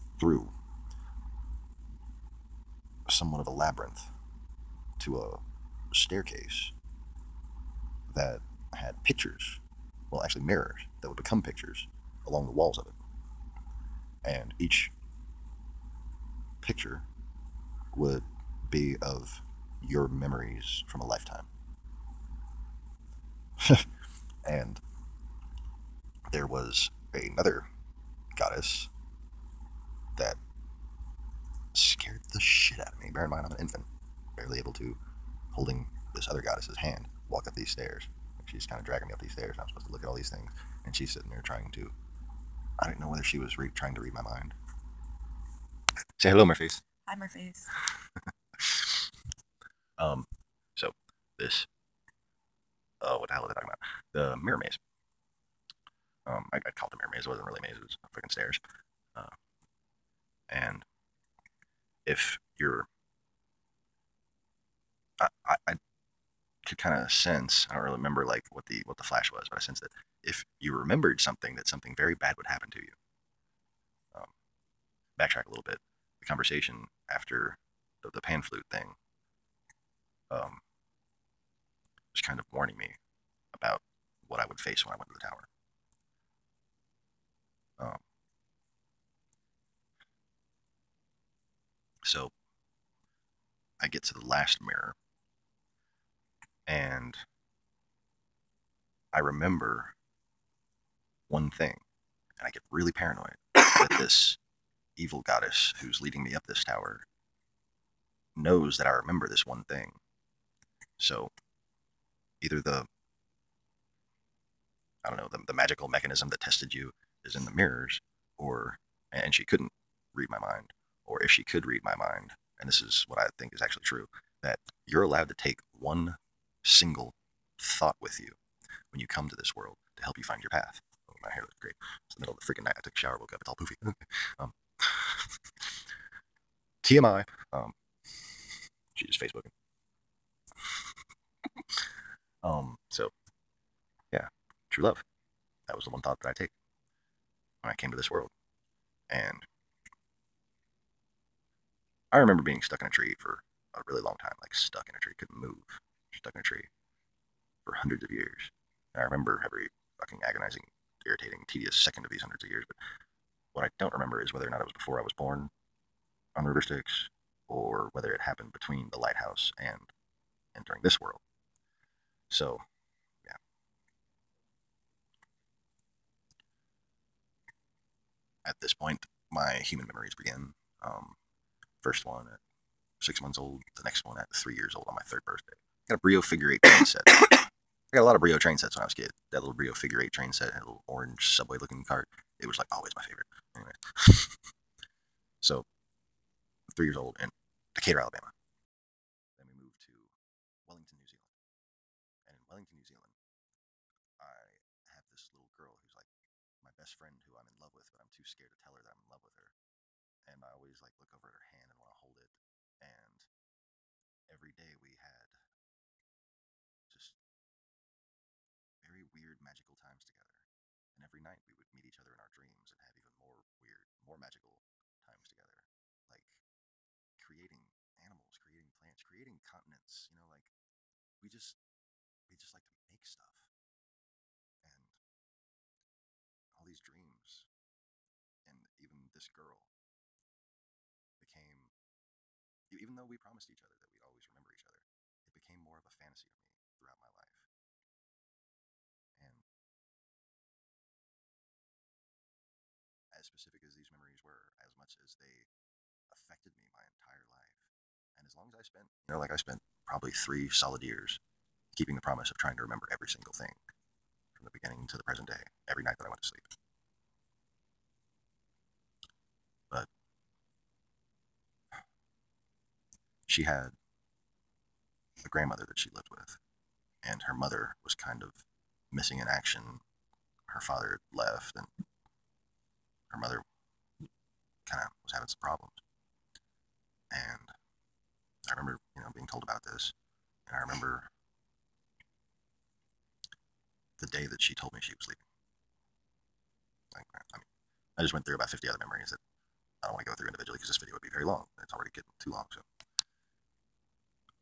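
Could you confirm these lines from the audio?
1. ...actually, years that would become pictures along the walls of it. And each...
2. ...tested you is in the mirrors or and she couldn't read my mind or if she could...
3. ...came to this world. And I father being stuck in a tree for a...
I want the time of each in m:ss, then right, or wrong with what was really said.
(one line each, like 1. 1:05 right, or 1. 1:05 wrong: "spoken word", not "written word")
1. 0:10 wrong: "mirrors", not "years"
2. 1:56 right
3. 2:27 wrong: "remember", not "father".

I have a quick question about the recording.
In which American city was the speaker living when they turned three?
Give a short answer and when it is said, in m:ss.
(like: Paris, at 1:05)
Decatur, Alabama, at 3:17.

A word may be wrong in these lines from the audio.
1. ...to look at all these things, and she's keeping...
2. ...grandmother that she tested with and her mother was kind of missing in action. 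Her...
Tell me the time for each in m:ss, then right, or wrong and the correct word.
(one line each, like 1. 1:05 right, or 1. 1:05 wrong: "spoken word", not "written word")
1. 0:39 wrong: "sitting", not "keeping"
2. 4:35 wrong: "lived", not "tested".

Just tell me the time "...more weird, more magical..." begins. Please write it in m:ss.
3:43.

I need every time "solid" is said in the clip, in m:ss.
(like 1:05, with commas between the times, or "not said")
4:20.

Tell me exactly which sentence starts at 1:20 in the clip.
Um, was kind of warning me about what I would face when I went to the tower.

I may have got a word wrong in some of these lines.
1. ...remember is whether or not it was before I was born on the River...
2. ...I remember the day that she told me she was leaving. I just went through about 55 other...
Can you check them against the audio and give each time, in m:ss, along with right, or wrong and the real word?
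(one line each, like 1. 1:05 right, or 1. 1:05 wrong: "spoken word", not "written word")
1. 2:43 right
2. 4:50 wrong: "50", not "55".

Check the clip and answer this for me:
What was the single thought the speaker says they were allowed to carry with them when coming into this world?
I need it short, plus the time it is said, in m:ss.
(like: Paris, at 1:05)
True love, at 2:24.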